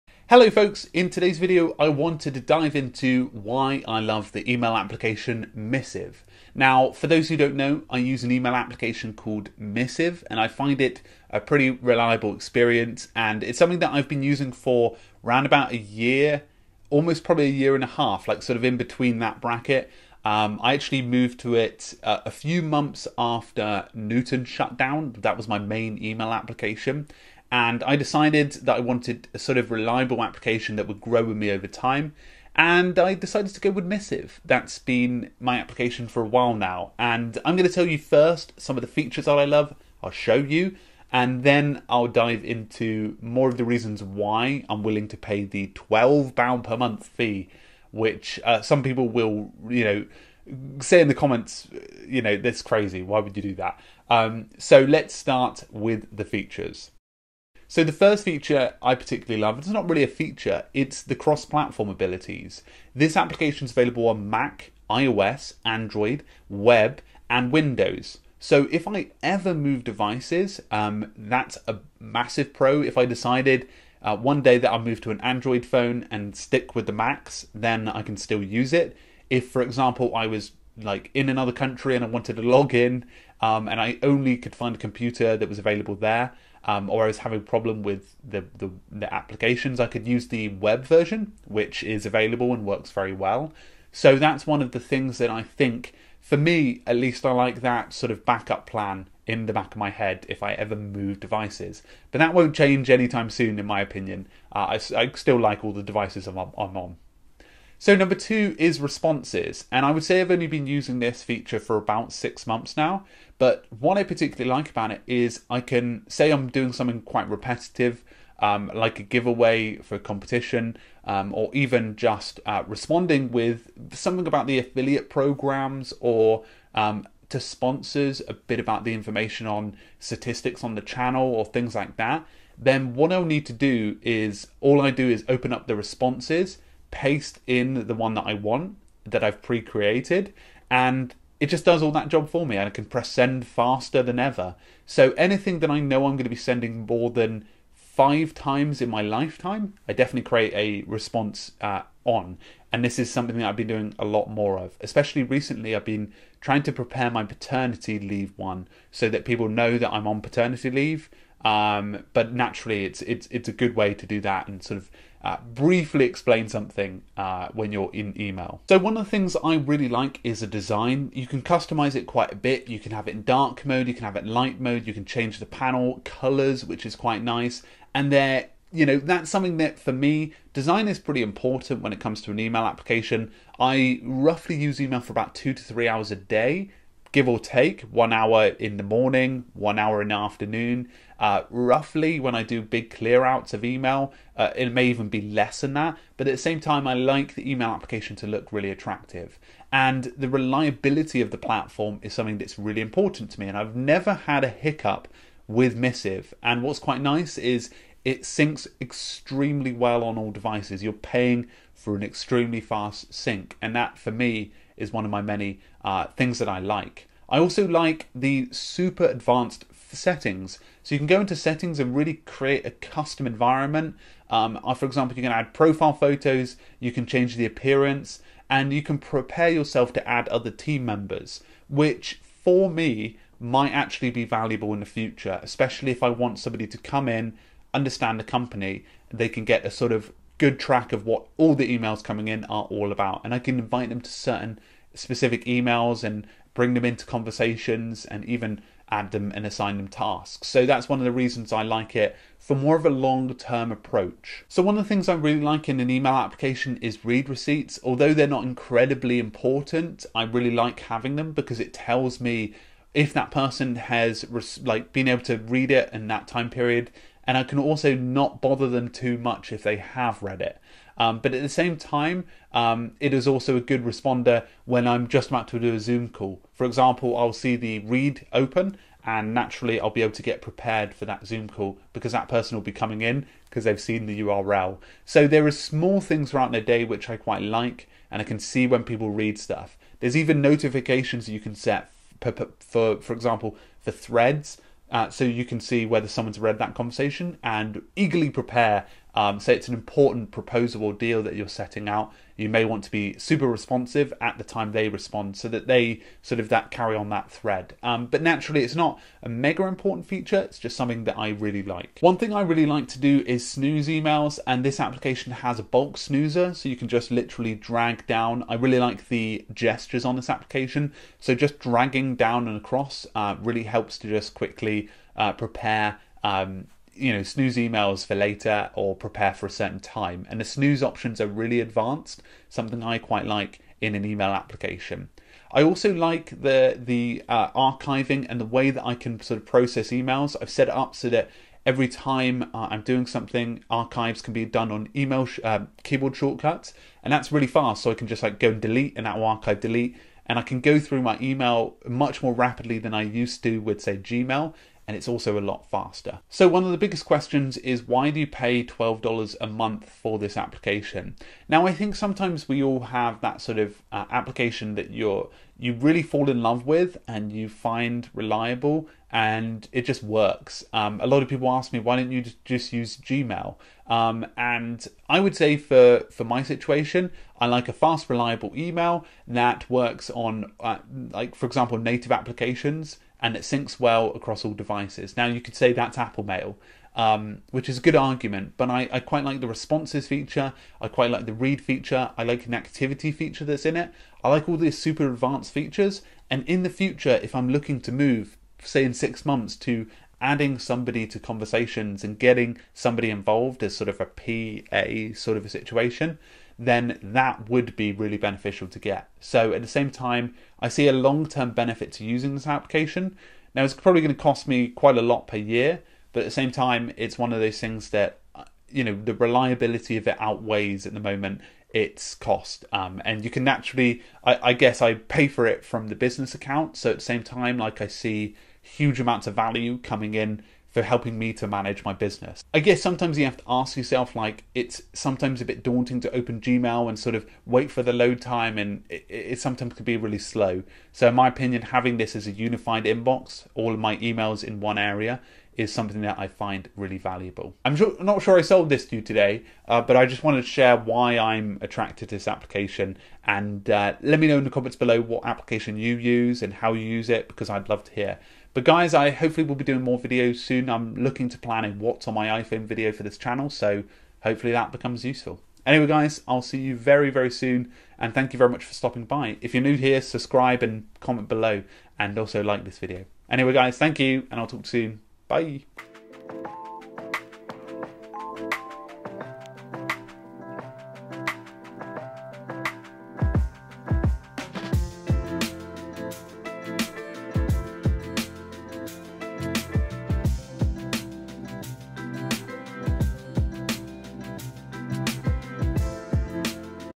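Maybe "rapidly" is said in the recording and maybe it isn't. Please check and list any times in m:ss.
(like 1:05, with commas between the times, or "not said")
5:52.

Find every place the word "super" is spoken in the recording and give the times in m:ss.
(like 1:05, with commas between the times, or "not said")
3:38, 5:03, 6:34.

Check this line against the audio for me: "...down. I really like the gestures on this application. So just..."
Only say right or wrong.
right.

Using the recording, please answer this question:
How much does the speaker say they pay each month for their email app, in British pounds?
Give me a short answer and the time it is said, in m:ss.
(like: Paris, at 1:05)
£12, at 0:45.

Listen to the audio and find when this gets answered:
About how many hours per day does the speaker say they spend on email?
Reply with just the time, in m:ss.
3:05.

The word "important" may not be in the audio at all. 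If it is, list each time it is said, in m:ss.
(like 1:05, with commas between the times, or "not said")
3:01, 3:22, 4:19, 4:59, 5:09.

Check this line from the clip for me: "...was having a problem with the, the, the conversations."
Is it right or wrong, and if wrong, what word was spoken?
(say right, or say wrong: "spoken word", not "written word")
wrong: "applications", not "conversations".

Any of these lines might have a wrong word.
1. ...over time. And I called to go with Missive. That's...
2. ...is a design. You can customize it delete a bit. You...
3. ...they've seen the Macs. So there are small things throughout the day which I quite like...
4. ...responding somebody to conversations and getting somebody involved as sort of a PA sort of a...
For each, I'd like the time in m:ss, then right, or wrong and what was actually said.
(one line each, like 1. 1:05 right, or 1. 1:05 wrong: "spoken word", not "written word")
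1. 0:31 wrong: "decided", not "called"
2. 2:50 wrong: "quite", not "delete"
3. 4:43 wrong: "URL", not "Macs"
4. 6:40 wrong: "adding", not "responding".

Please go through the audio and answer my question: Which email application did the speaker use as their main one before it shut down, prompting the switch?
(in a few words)
Newton.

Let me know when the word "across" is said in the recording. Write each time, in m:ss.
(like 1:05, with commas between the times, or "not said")
5:22, 6:24.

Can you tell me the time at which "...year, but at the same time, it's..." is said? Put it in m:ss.
6:55.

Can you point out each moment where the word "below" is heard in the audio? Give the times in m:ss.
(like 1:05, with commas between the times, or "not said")
7:34, 7:51.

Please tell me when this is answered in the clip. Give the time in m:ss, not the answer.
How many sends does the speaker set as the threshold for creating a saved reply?
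2:27.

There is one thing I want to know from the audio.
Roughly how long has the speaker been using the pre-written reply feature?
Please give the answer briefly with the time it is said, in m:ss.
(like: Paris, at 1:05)
6 months, at 1:51.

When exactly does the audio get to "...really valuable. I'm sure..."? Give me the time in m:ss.
7:26.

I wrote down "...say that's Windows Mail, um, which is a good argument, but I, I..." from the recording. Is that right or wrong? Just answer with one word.
wrong.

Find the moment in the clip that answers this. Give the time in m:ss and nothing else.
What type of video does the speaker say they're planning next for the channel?
7:41.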